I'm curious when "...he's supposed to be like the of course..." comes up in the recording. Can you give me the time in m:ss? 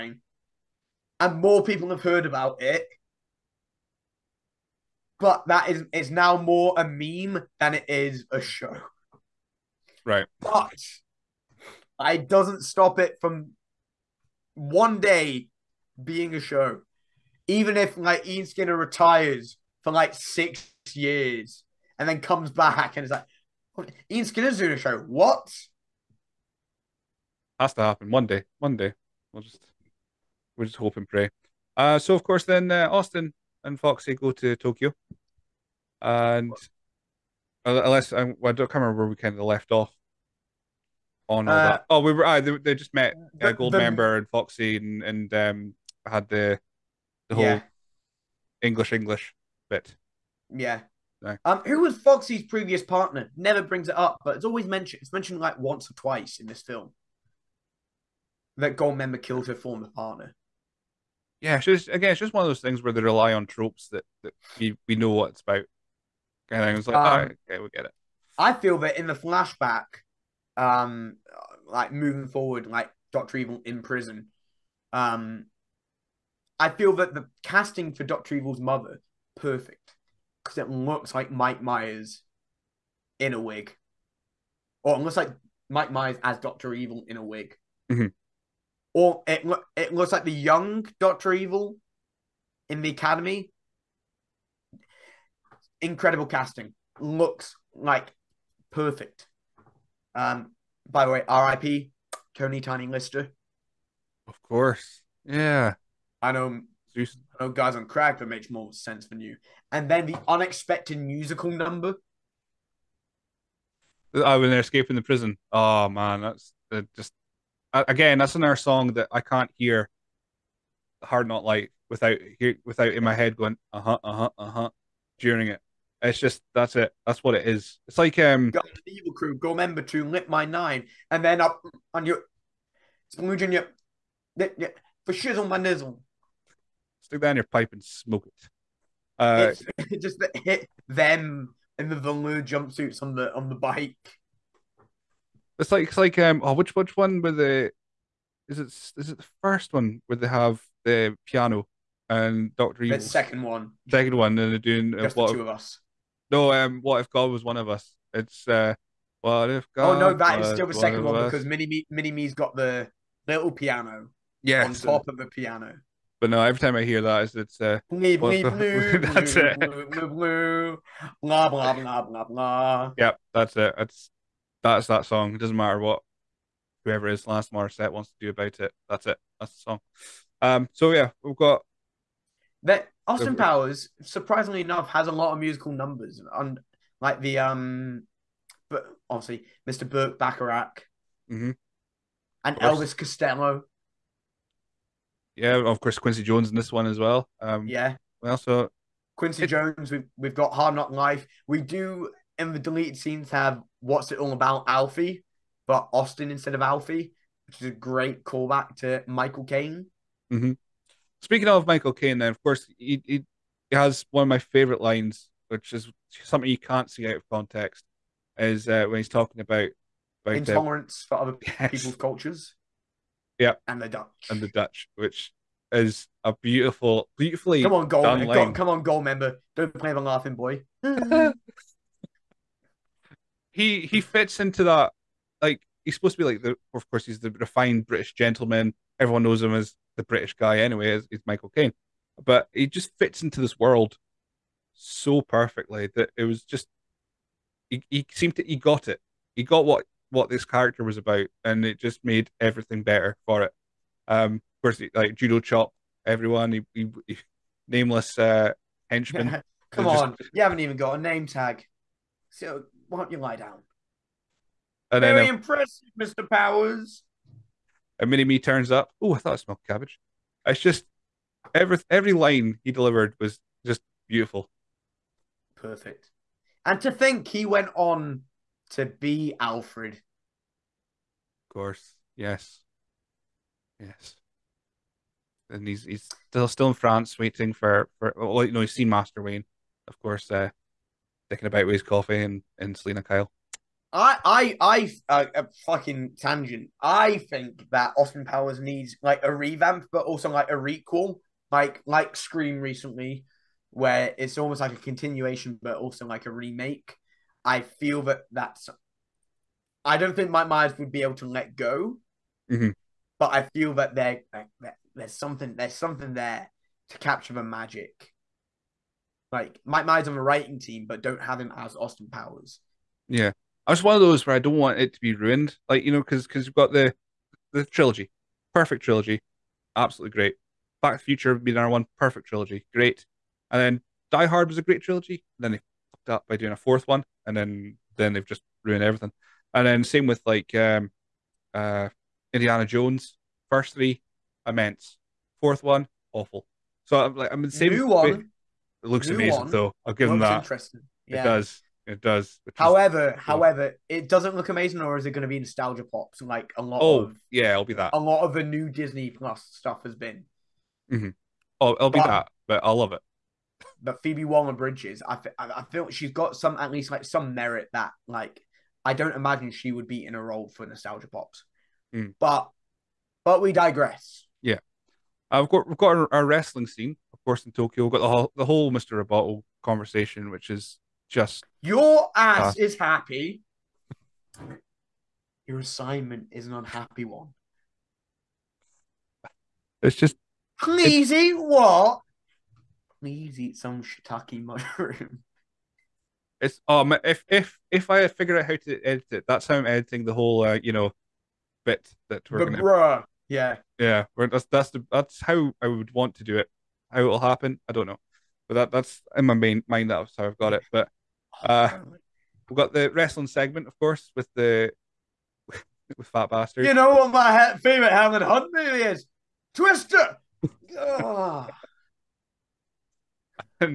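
3:55.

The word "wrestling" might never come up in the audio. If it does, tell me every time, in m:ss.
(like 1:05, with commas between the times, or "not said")
6:16, 6:52.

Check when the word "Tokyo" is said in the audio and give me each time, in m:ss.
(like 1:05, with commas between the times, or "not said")
0:34, 6:17.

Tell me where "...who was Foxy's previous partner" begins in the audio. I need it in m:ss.
0:51.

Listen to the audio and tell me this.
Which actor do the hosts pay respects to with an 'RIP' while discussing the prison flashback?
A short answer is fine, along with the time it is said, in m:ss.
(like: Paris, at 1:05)
Tony Tiny Lister, at 1:42.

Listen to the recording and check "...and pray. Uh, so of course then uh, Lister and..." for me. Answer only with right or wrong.
wrong.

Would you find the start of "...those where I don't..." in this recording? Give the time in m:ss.
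5:24.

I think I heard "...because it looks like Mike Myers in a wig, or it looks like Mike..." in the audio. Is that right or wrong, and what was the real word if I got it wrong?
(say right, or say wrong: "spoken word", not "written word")
right.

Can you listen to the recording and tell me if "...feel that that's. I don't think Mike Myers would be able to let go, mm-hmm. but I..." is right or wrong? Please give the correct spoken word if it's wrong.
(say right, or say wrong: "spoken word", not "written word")
right.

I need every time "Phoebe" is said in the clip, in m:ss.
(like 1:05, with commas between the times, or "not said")
6:04.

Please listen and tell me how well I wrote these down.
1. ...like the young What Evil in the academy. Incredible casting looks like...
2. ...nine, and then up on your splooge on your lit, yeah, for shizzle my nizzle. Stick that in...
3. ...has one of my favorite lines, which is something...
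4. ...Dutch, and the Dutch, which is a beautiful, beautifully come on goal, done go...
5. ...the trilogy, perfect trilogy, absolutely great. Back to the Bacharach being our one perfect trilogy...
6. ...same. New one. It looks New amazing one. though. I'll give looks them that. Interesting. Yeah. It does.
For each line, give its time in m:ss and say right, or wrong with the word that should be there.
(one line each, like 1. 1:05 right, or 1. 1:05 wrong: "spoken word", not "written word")
1. 1:30 wrong: "Doctor", not "What"
2. 2:10 right
3. 3:33 right
4. 3:43 right
5. 5:27 wrong: "Future", not "Bacharach"
6. 5:47 right.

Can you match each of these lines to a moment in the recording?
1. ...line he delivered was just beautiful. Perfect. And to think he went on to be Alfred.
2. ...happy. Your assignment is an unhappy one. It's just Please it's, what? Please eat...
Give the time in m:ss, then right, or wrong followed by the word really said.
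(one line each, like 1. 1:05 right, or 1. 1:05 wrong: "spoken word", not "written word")
1. 4:32 right
2. 6:22 right.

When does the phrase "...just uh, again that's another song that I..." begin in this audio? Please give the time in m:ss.
1:56.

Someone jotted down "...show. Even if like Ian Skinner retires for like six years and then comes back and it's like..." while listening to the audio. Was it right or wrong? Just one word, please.
right.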